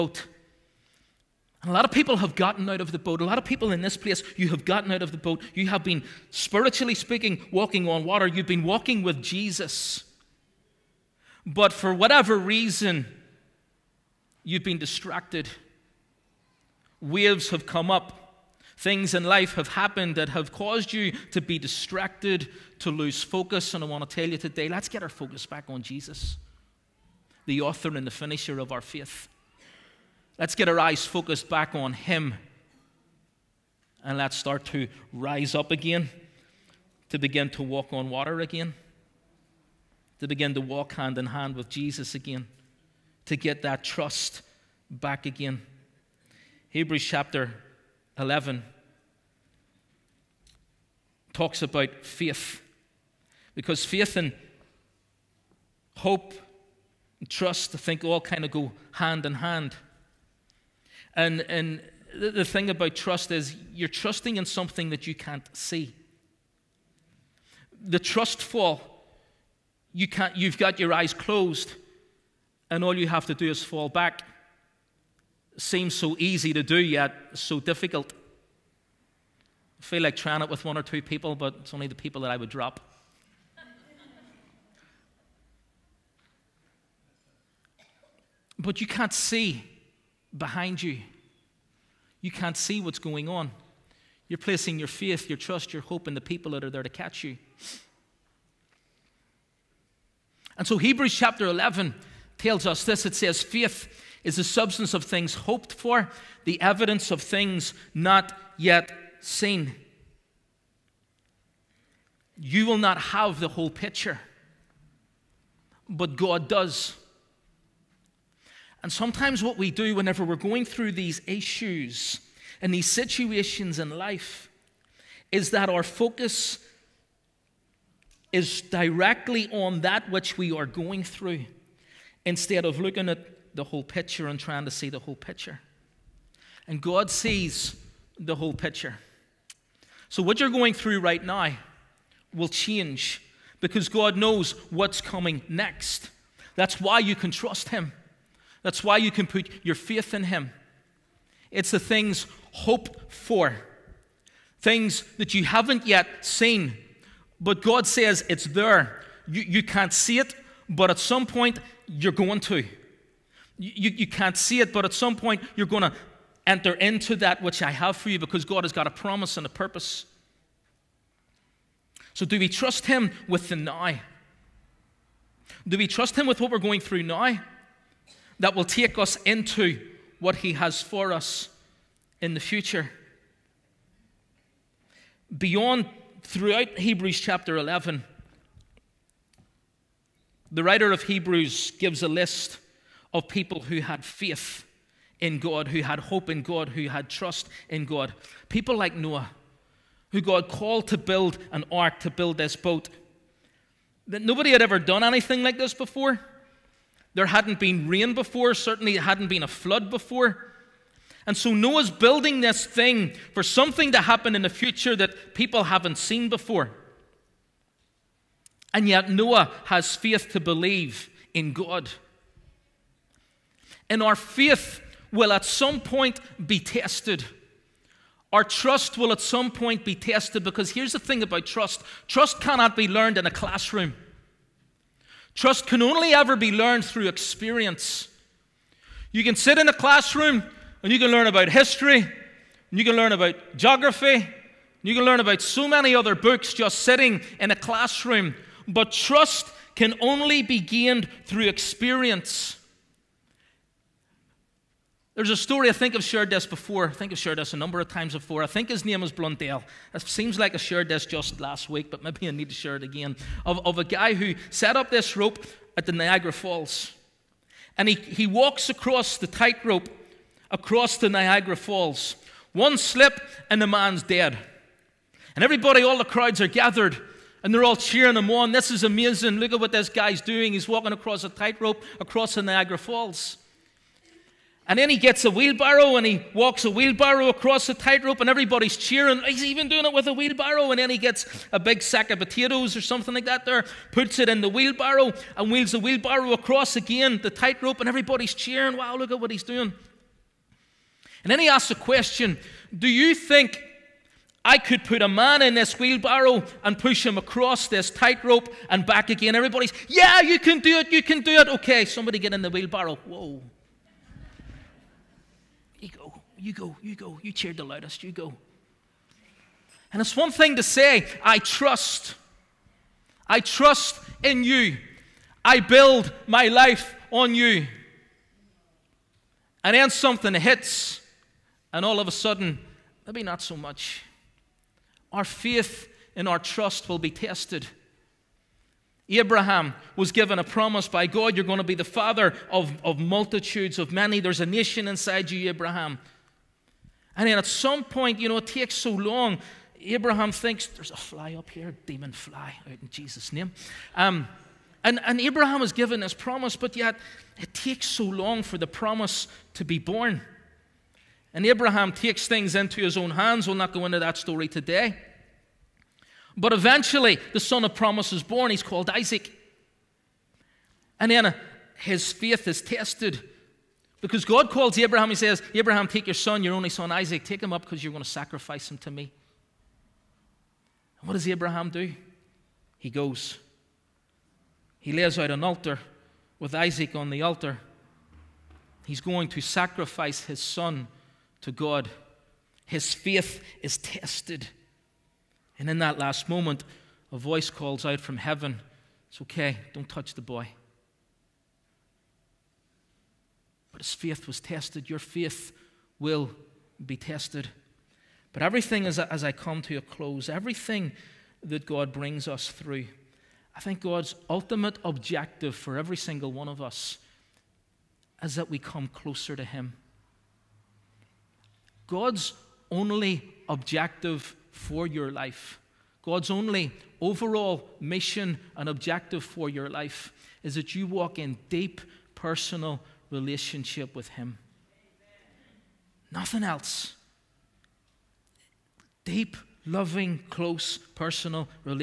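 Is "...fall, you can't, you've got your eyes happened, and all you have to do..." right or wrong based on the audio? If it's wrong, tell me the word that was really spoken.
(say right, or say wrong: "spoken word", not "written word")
wrong: "closed", not "happened".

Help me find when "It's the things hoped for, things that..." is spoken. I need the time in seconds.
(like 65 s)
151 s.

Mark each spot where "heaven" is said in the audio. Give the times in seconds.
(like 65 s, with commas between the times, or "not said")
398 s.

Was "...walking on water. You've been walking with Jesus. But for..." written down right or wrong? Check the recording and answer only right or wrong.
right.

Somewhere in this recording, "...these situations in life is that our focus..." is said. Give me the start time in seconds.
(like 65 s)
122 s.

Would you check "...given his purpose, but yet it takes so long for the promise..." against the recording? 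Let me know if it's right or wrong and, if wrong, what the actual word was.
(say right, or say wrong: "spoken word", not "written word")
wrong: "promise", not "purpose".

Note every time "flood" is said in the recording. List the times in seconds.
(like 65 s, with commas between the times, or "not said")
209 s.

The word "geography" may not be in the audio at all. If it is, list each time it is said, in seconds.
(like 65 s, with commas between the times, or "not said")
243 s.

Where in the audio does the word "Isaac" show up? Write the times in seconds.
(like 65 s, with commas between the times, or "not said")
368 s, 376 s, 386 s.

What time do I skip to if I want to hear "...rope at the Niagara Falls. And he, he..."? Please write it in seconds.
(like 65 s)
265 s.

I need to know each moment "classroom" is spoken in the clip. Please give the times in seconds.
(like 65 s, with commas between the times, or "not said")
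233 s, 239 s, 247 s.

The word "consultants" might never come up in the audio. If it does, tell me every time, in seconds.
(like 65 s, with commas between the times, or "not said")
not said.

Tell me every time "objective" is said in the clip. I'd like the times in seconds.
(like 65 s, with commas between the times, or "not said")
414 s, 423 s, 428 s.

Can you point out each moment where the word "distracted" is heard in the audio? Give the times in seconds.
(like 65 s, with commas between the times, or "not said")
14 s, 21 s.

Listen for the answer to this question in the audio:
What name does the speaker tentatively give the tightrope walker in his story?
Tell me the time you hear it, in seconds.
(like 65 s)
259 s.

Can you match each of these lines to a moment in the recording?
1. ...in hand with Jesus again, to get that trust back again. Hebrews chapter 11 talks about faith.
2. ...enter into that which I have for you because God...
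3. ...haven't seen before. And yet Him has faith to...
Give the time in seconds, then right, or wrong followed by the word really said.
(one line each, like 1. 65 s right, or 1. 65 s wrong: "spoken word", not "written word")
1. 41 s right
2. 166 s right
3. 215 s wrong: "Noah", not "Him".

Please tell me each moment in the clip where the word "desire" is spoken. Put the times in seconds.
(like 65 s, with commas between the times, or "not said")
not said.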